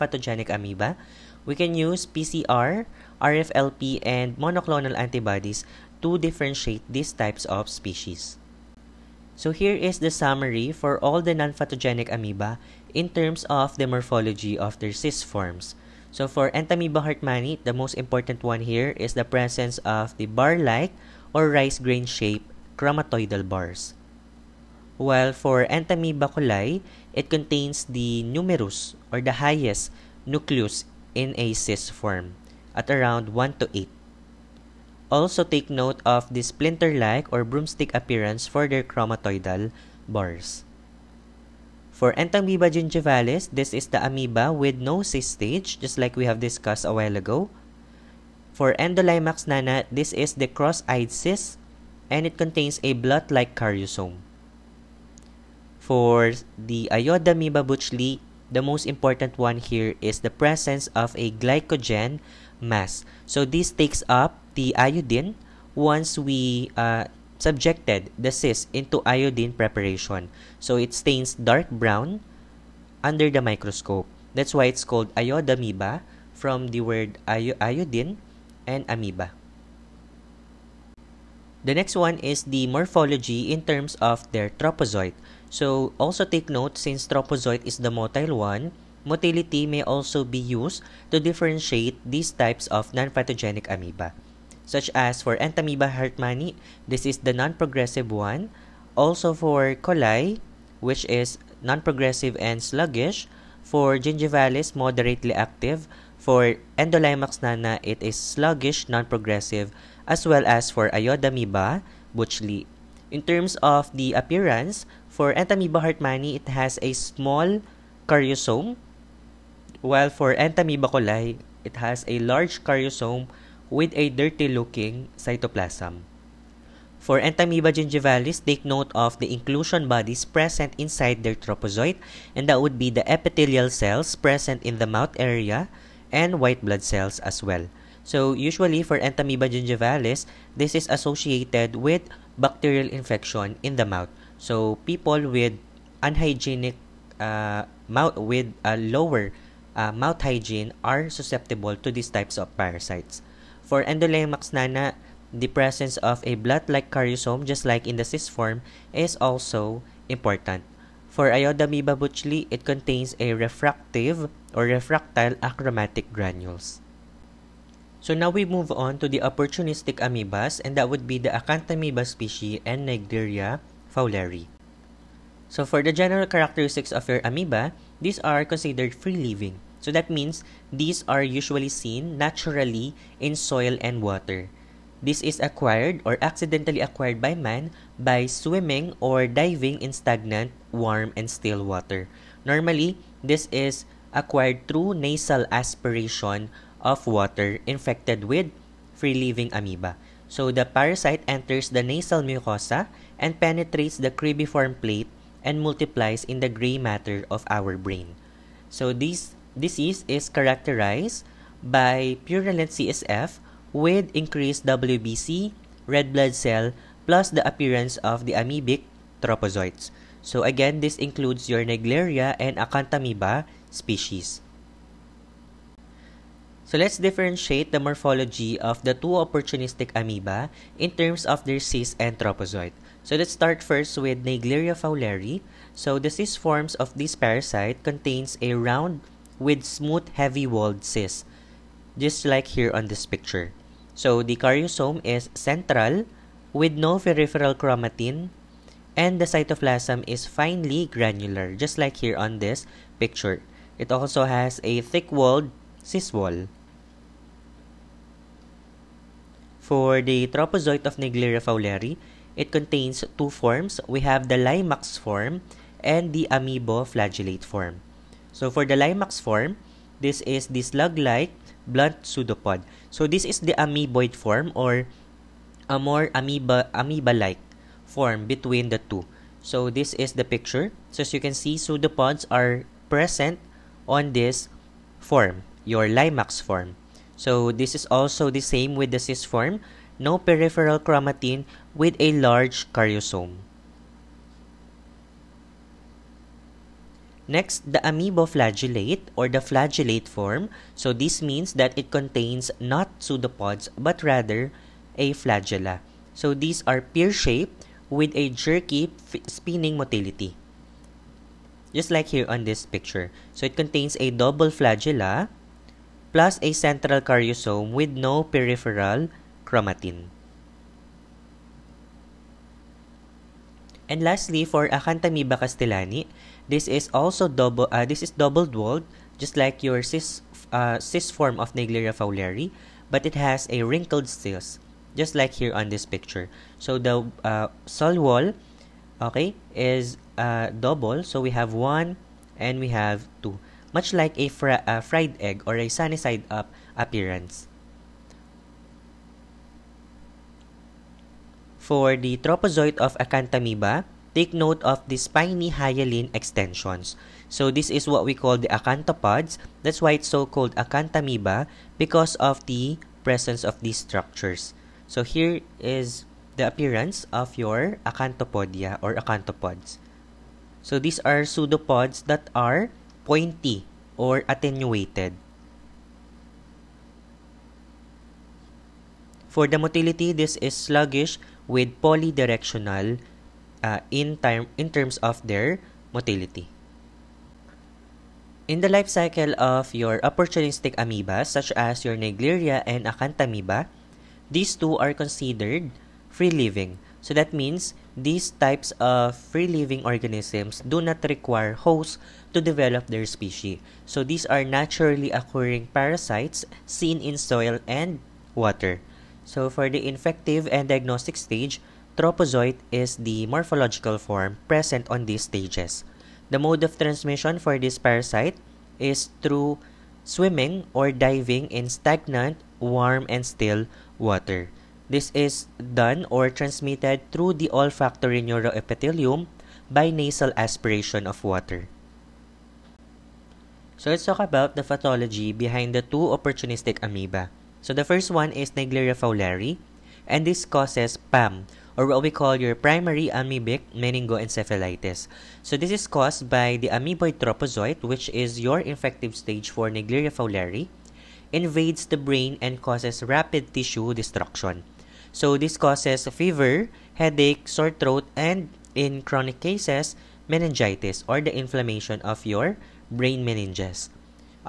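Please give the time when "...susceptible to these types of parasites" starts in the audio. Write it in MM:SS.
02:31.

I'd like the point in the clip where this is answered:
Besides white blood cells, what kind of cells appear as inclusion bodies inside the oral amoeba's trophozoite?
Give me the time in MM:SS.
02:13.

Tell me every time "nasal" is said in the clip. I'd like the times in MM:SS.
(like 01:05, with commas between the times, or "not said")
03:14, 03:21, 07:09.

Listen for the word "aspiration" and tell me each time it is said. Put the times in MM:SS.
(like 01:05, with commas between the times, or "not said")
03:15, 07:10.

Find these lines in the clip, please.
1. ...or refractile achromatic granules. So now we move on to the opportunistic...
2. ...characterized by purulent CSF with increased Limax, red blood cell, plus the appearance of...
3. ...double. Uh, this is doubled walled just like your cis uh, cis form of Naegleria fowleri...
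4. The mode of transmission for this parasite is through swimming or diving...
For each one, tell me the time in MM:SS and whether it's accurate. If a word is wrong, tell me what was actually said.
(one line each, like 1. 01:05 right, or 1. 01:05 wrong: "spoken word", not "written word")
1. 02:44 right
2. 03:30 wrong: "WBC", not "Limax"
3. 05:27 right
4. 06:56 right.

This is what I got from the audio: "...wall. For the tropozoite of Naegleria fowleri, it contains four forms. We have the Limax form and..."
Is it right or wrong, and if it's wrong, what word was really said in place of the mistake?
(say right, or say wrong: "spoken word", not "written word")
wrong: "two", not "four".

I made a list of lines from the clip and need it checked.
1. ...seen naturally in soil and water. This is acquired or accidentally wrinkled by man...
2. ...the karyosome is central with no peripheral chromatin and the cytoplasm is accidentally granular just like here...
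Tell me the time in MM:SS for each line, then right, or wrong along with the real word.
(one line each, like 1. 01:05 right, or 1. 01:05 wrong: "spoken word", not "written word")
1. 03:01 wrong: "acquired", not "wrinkled"
2. 04:04 wrong: "finely", not "accidentally".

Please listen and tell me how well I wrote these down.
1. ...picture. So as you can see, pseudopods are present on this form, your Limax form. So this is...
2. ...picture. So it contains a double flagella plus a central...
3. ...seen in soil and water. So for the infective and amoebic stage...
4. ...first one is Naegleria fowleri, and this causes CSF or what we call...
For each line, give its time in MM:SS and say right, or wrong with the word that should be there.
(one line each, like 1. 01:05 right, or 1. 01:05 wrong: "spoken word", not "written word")
1. 04:40 right
2. 05:12 right
3. 06:46 wrong: "diagnostic", not "amoebic"
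4. 07:17 wrong: "PAM", not "CSF".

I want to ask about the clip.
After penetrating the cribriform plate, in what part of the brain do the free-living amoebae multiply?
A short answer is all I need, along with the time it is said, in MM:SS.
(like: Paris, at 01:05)
Gray matter, at 03:26.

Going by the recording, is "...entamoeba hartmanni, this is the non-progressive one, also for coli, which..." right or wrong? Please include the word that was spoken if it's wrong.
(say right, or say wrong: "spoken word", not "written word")
right.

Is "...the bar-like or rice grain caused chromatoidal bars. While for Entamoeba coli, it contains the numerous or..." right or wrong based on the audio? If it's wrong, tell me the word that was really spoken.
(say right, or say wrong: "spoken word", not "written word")
wrong: "shaped", not "caused".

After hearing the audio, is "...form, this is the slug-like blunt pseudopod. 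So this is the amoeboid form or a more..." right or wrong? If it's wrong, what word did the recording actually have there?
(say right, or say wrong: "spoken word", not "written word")
right.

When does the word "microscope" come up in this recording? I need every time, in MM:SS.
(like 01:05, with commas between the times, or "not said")
01:13.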